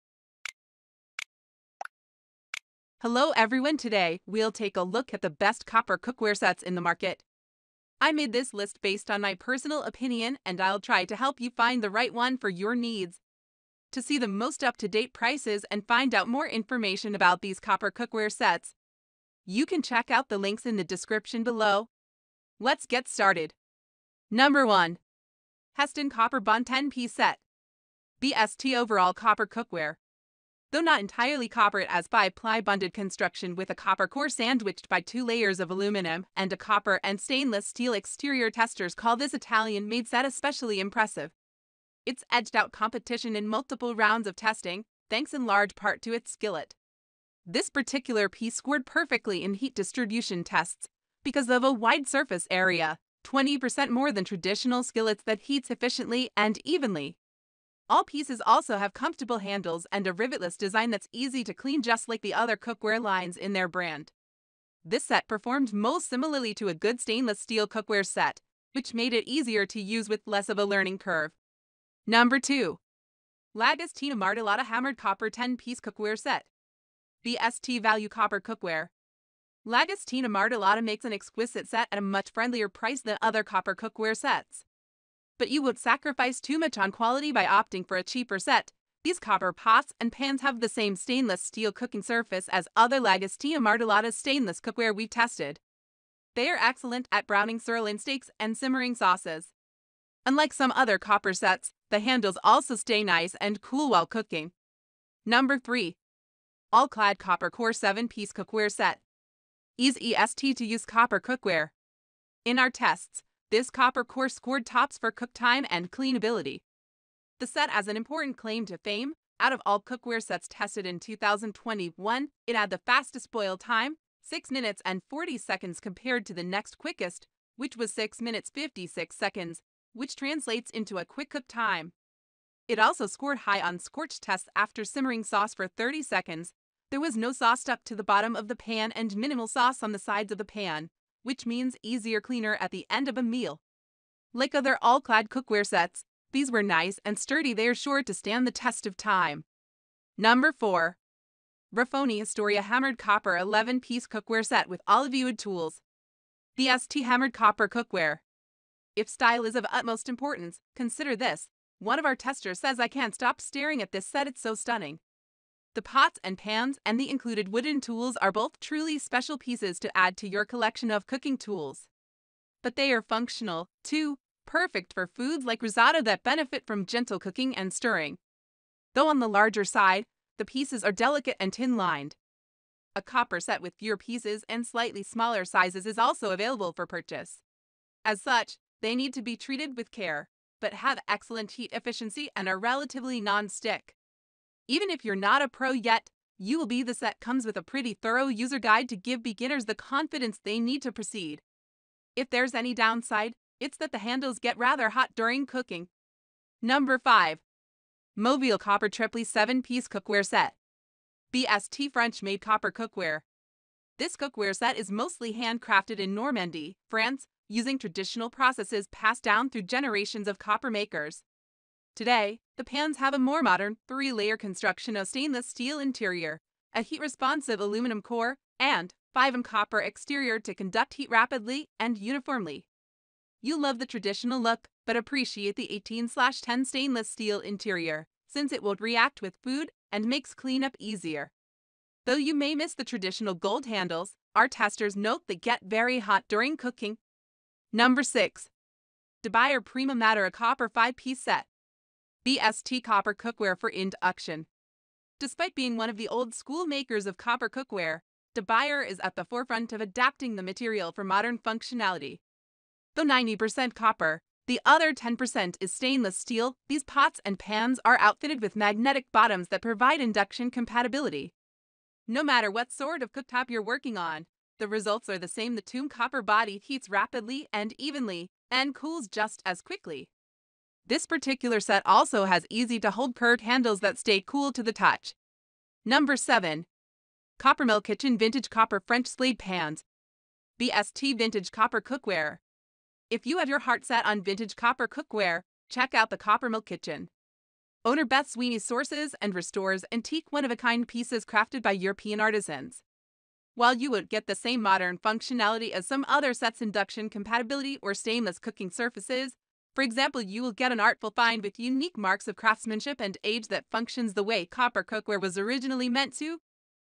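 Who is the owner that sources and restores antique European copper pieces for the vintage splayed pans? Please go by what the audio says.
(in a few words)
Beth Sweeney.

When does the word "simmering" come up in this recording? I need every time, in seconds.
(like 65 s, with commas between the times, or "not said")
98 s, 134 s.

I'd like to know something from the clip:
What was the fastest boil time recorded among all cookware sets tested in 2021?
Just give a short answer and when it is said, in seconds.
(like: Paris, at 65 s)
6 minutes 40 seconds, at 124 s.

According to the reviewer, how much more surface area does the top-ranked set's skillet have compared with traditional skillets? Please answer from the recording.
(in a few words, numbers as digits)
20%.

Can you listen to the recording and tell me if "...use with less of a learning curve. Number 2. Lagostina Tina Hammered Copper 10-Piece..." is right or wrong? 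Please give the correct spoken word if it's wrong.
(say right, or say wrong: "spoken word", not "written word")
right.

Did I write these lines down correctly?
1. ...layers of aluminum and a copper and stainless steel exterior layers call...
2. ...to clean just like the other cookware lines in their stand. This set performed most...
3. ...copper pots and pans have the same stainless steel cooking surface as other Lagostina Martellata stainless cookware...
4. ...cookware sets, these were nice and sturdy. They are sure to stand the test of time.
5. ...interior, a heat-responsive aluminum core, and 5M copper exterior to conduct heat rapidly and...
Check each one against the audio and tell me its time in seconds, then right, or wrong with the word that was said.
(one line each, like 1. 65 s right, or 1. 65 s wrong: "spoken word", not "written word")
1. 35 s wrong: "testers", not "layers"
2. 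61 s wrong: "brand", not "stand"
3. 89 s right
4. 145 s right
5. 225 s right.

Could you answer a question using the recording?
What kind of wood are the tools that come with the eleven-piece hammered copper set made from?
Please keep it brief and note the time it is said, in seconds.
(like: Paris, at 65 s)
Olivewood, at 154 s.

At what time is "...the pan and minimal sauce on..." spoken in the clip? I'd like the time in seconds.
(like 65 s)
138 s.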